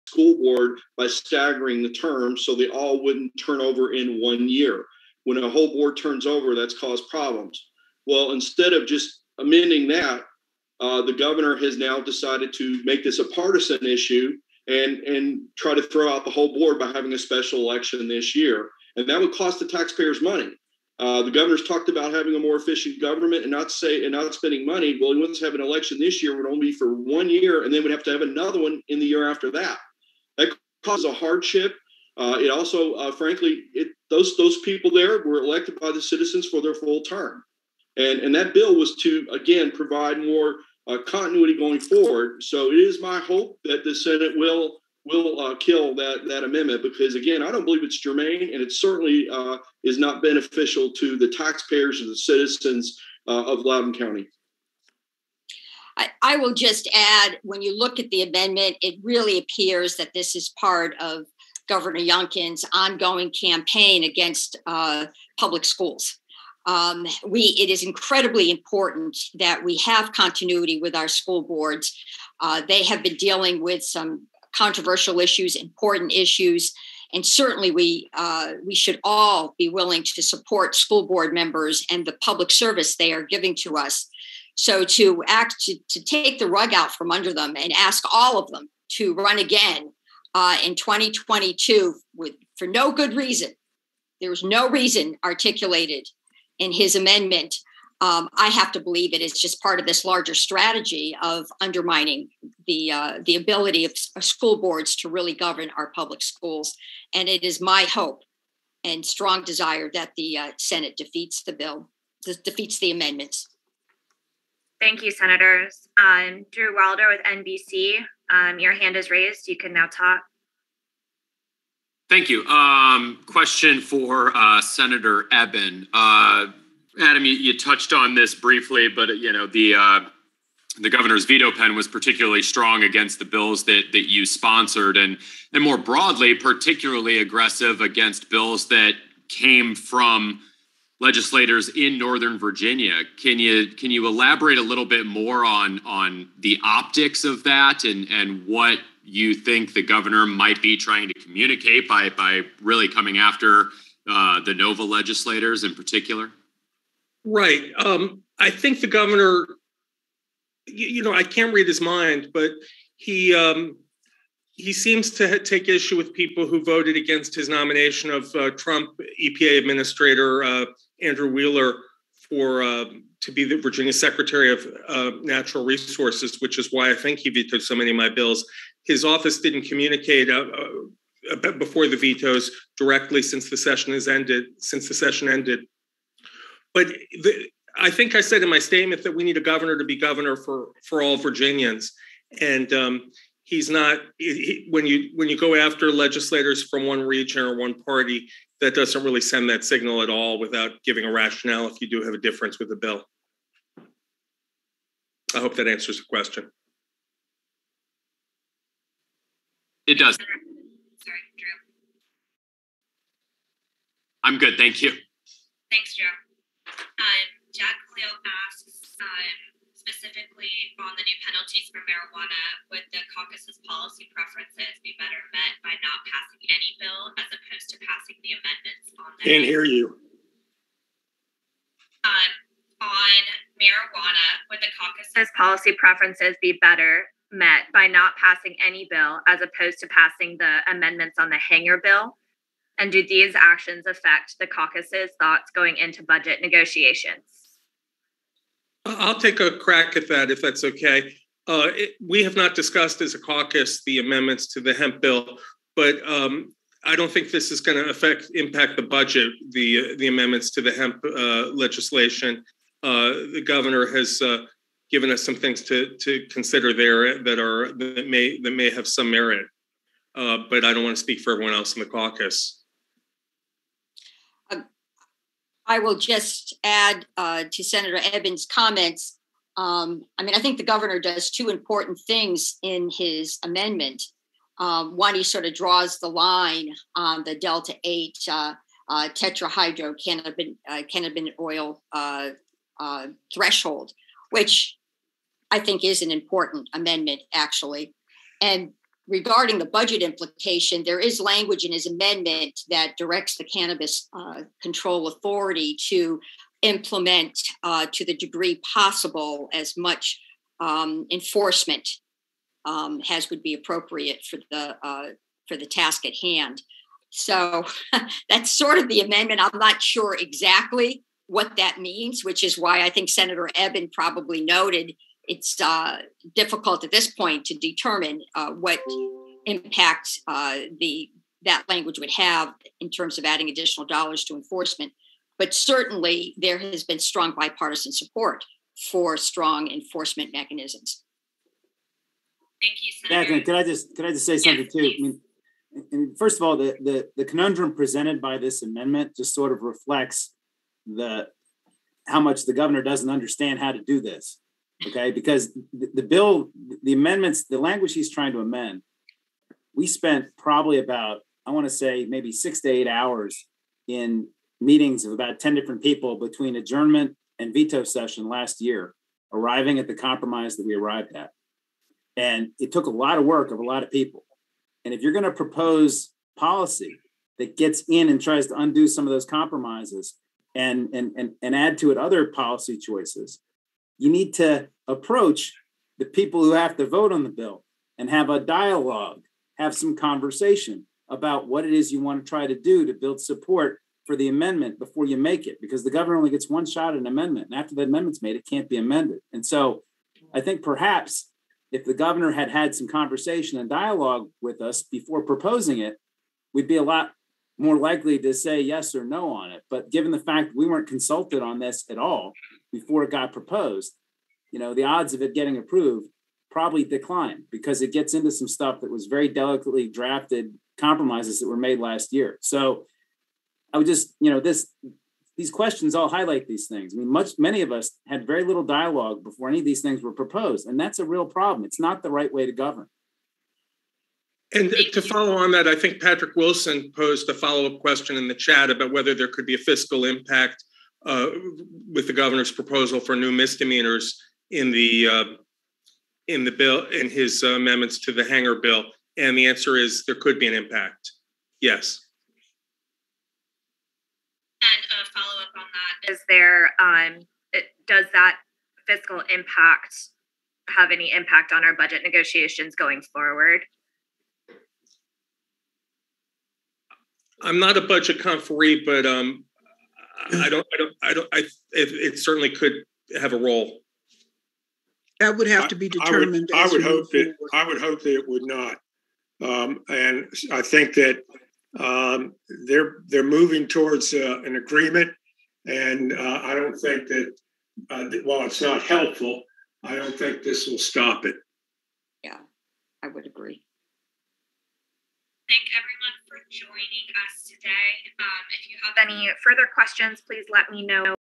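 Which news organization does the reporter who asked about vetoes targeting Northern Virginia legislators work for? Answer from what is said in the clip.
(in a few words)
NBC.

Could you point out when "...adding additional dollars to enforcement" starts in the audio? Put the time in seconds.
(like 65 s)
333 s.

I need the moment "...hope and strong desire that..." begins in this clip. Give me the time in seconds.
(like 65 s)
107 s.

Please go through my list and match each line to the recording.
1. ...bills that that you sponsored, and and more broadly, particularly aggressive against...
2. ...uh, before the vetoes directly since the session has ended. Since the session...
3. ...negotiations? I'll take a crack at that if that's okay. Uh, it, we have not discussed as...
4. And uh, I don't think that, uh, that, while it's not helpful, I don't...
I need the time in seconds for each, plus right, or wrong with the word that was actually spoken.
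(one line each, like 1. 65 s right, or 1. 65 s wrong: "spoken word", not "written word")
1. 133 s right
2. 181 s right
3. 246 s right
4. 485 s right.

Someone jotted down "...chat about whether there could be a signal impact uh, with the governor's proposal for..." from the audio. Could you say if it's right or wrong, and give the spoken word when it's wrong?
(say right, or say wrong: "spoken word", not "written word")
wrong: "fiscal", not "signal".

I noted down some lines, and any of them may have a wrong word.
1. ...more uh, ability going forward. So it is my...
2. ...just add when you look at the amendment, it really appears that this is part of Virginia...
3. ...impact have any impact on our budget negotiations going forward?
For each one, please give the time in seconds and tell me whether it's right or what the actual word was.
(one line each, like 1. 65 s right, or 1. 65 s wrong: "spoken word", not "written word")
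1. 40 s wrong: "continuity", not "ability"
2. 56 s wrong: "Governor", not "Virginia"
3. 459 s right.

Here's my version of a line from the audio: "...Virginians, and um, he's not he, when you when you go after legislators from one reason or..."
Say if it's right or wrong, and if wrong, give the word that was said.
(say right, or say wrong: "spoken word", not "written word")
wrong: "region", not "reason".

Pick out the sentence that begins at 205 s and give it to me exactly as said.
I hope that answers the question.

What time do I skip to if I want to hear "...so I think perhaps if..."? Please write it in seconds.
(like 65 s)
399 s.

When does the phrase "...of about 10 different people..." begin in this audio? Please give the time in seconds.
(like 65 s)
365 s.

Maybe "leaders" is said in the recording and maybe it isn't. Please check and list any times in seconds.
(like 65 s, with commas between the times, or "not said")
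not said.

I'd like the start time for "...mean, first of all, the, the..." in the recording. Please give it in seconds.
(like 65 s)
345 s.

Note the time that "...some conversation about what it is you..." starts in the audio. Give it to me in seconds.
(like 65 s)
389 s.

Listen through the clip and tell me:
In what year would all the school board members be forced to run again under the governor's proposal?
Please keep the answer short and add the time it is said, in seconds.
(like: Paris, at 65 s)
2022, at 90 s.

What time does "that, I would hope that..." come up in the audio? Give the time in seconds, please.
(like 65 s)
477 s.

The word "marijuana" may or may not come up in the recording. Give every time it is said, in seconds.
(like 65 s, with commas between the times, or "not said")
221 s, 233 s.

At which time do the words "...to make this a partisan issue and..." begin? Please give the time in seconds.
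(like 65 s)
12 s.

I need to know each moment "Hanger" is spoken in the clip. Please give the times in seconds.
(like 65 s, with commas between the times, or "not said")
241 s, 448 s.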